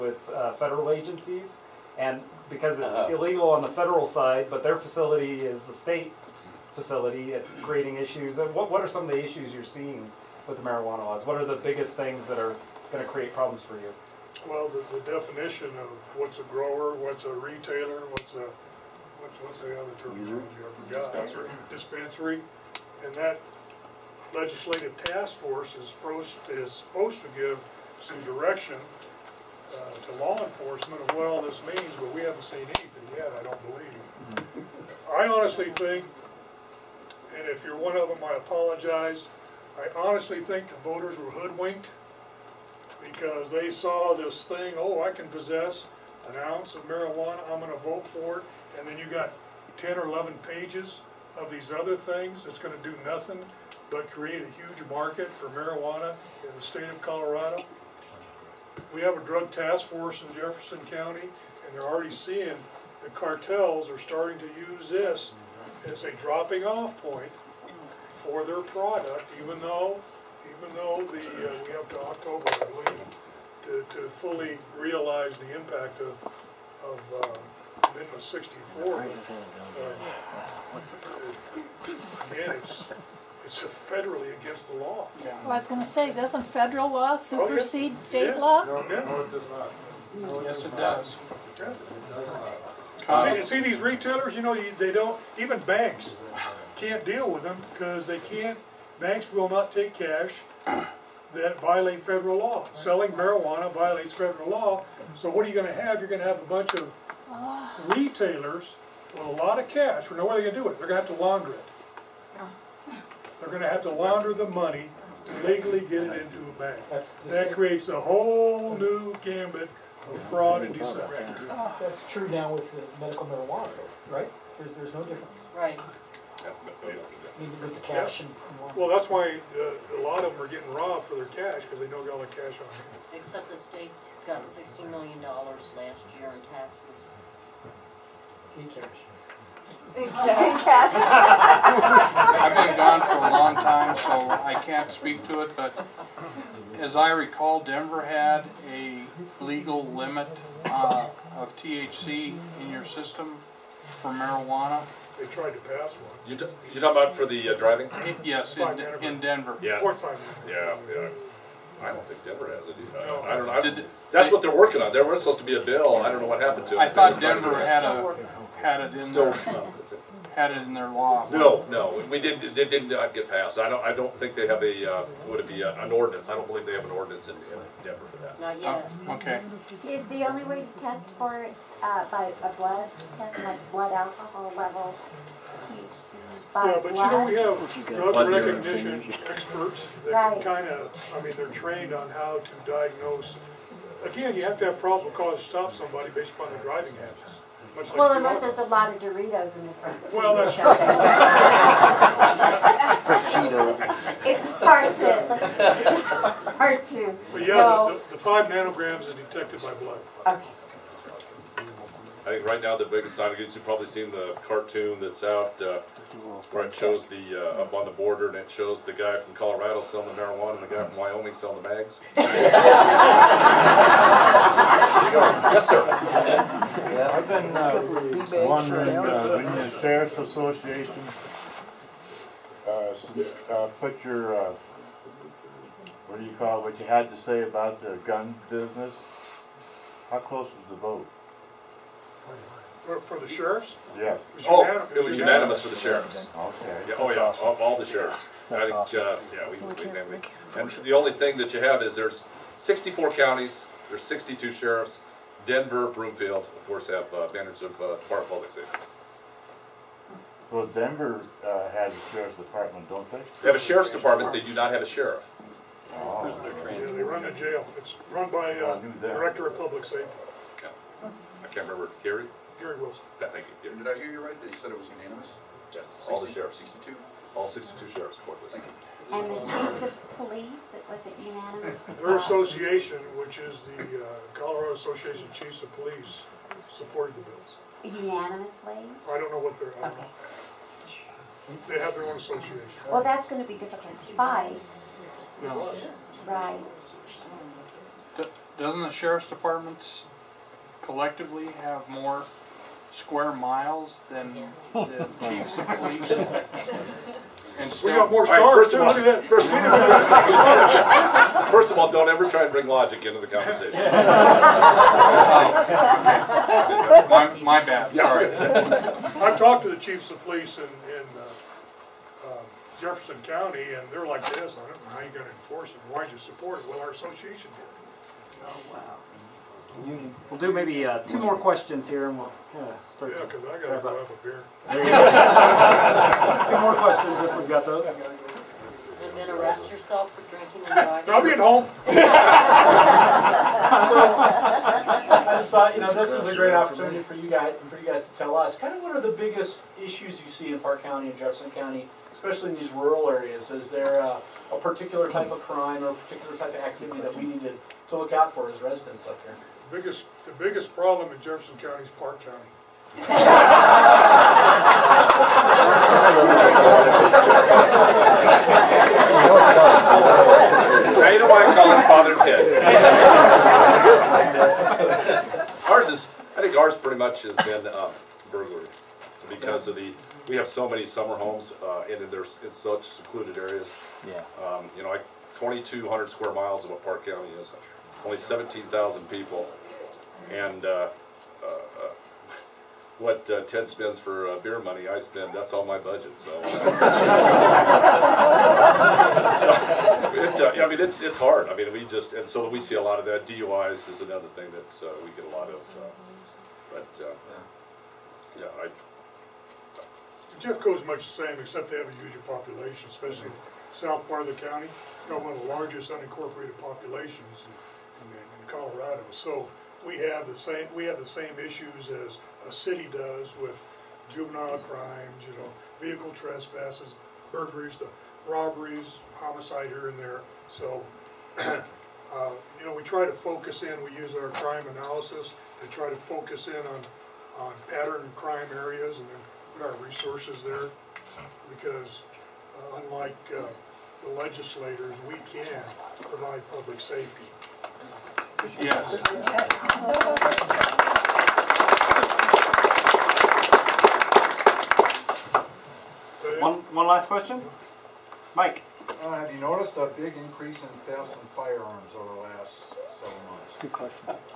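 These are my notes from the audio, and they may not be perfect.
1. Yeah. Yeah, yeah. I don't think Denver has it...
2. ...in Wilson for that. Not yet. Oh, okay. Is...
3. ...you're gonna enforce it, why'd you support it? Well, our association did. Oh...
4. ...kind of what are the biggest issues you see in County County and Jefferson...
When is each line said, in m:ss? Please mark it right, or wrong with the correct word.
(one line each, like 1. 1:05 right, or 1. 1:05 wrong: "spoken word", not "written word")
1. 2:39 right
2. 2:57 wrong: "Denver", not "Wilson"
3. 5:25 right
4. 5:48 wrong: "Park", not "County".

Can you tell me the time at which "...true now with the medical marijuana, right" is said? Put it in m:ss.
2:02.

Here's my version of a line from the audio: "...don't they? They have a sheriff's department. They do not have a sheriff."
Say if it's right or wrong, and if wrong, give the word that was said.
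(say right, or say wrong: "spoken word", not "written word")
right.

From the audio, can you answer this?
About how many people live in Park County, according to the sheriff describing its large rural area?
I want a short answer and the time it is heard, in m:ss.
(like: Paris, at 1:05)
17,000, at 6:28.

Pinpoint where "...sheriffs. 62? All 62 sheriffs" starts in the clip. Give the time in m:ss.
4:36.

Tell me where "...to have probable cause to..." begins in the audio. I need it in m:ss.
3:14.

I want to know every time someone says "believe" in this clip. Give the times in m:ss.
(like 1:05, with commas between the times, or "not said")
0:33, 1:12, 2:56.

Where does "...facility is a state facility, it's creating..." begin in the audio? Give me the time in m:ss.
0:04.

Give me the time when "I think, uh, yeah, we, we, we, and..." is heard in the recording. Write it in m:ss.
4:08.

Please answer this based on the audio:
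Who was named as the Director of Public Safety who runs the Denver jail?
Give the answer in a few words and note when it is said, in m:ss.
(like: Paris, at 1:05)
Gary Wilson, at 4:32.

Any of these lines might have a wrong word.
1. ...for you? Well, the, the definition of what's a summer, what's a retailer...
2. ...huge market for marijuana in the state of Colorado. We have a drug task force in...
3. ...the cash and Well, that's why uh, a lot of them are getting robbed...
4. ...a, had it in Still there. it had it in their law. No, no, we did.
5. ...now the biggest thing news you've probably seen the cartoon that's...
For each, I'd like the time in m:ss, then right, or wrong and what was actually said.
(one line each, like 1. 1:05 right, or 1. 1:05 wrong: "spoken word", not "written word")
1. 0:13 wrong: "grower", not "summer"
2. 0:54 right
3. 2:07 right
4. 2:47 right
5. 3:32 right.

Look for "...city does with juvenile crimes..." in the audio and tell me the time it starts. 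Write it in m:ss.
7:02.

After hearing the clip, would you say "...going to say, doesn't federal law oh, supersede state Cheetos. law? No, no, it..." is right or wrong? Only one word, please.
wrong.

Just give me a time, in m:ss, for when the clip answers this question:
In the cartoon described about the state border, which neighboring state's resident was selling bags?
3:40.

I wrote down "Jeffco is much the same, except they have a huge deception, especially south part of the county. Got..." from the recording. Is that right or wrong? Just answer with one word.
wrong.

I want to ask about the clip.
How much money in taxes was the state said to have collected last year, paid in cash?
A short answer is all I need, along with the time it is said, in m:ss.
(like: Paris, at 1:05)
$60 million, at 2:14.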